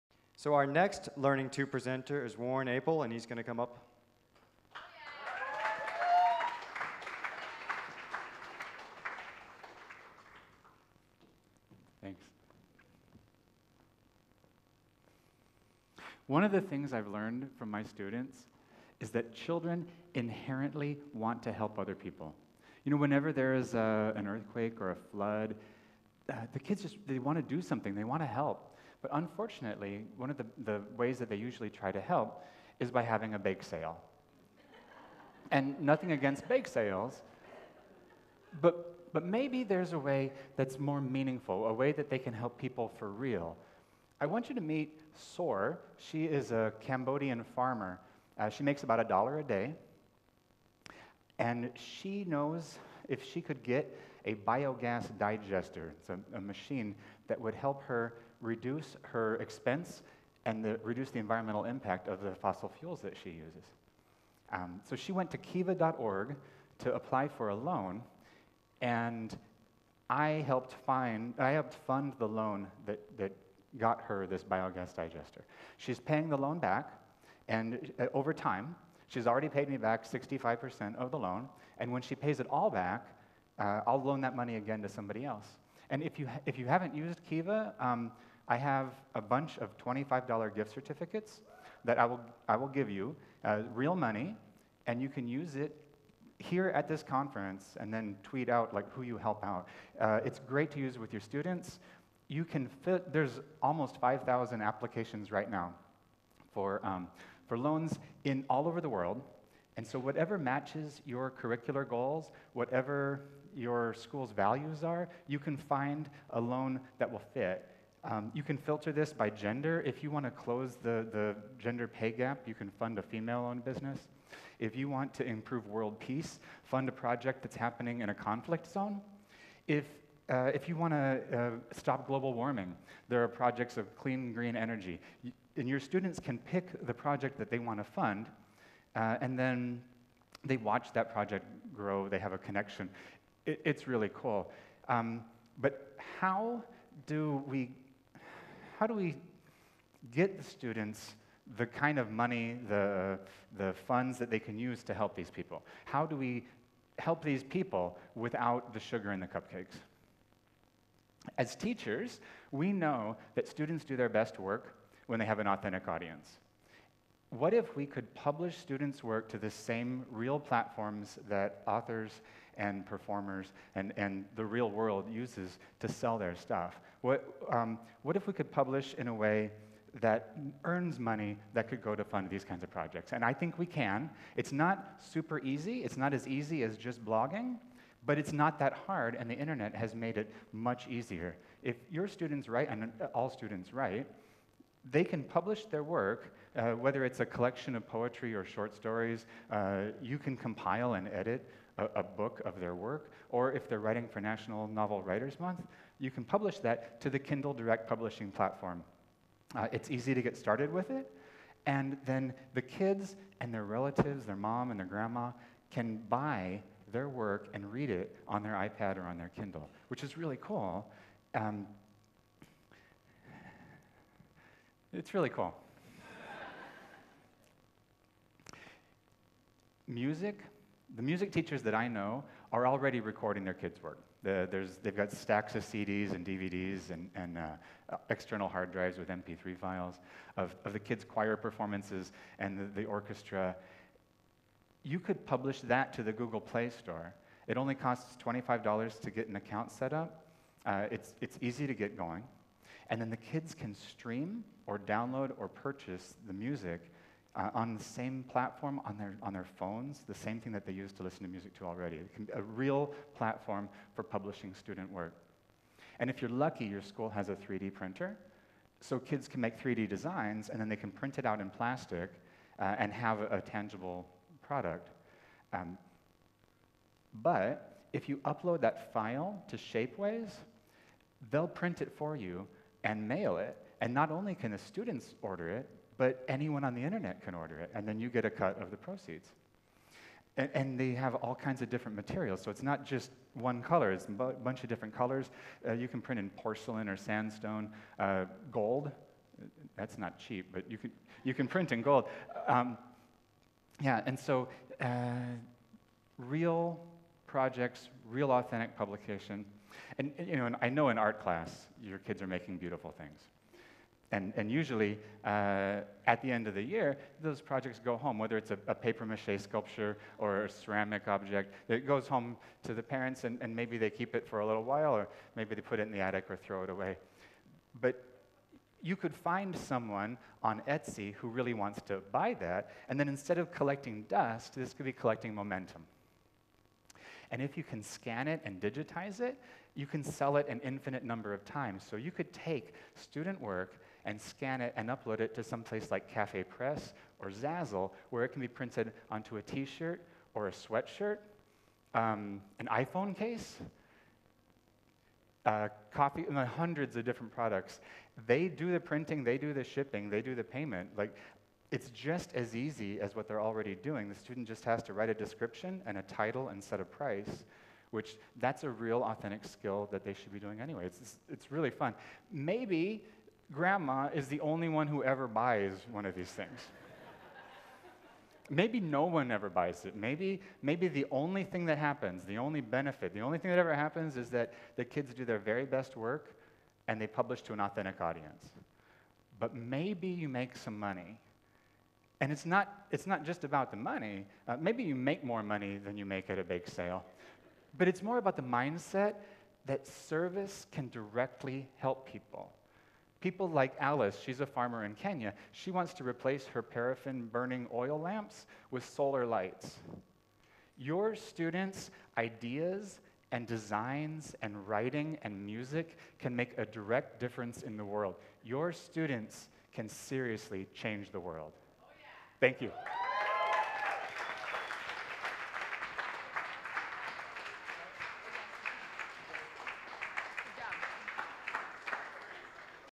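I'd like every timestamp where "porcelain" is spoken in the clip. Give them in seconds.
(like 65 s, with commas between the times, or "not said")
296 s.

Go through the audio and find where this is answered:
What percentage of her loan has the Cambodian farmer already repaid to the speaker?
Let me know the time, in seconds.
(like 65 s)
80 s.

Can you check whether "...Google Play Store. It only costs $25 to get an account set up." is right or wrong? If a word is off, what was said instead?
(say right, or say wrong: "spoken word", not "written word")
right.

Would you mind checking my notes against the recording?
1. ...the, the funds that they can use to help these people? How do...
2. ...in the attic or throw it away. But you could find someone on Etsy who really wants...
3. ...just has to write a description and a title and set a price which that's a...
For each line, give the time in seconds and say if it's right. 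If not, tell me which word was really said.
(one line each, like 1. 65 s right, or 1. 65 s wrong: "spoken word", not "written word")
1. 152 s right
2. 325 s right
3. 364 s right.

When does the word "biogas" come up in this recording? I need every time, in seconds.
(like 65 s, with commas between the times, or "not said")
54 s, 74 s.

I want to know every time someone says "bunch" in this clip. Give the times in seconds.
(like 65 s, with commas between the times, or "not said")
89 s, 294 s.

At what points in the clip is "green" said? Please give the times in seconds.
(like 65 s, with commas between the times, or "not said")
134 s.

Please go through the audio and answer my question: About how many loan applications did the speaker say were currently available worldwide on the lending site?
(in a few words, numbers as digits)
5,000.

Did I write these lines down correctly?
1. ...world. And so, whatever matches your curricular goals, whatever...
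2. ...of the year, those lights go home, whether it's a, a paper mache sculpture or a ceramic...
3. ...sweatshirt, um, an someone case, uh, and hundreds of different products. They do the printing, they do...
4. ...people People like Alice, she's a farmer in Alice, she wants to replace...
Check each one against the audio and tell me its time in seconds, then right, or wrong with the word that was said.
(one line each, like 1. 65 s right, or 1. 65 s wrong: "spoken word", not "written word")
1. 108 s right
2. 316 s wrong: "projects", not "lights"
3. 350 s wrong: "iPhone", not "someone"
4. 402 s wrong: "Kenya", not "Alice".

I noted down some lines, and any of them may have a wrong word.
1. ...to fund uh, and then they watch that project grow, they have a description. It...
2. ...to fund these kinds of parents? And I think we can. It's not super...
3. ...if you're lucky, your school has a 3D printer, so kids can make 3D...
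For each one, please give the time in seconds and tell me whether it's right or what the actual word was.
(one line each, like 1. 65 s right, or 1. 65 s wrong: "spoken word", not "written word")
1. 137 s wrong: "connection", not "description"
2. 181 s wrong: "projects", not "parents"
3. 266 s right.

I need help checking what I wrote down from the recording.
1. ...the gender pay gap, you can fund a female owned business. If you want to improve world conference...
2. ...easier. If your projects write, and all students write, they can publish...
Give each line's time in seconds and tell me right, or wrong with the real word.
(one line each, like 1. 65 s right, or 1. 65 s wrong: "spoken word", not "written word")
1. 121 s wrong: "peace", not "conference"
2. 190 s wrong: "students", not "projects".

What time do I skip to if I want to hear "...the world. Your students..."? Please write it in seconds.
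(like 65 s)
417 s.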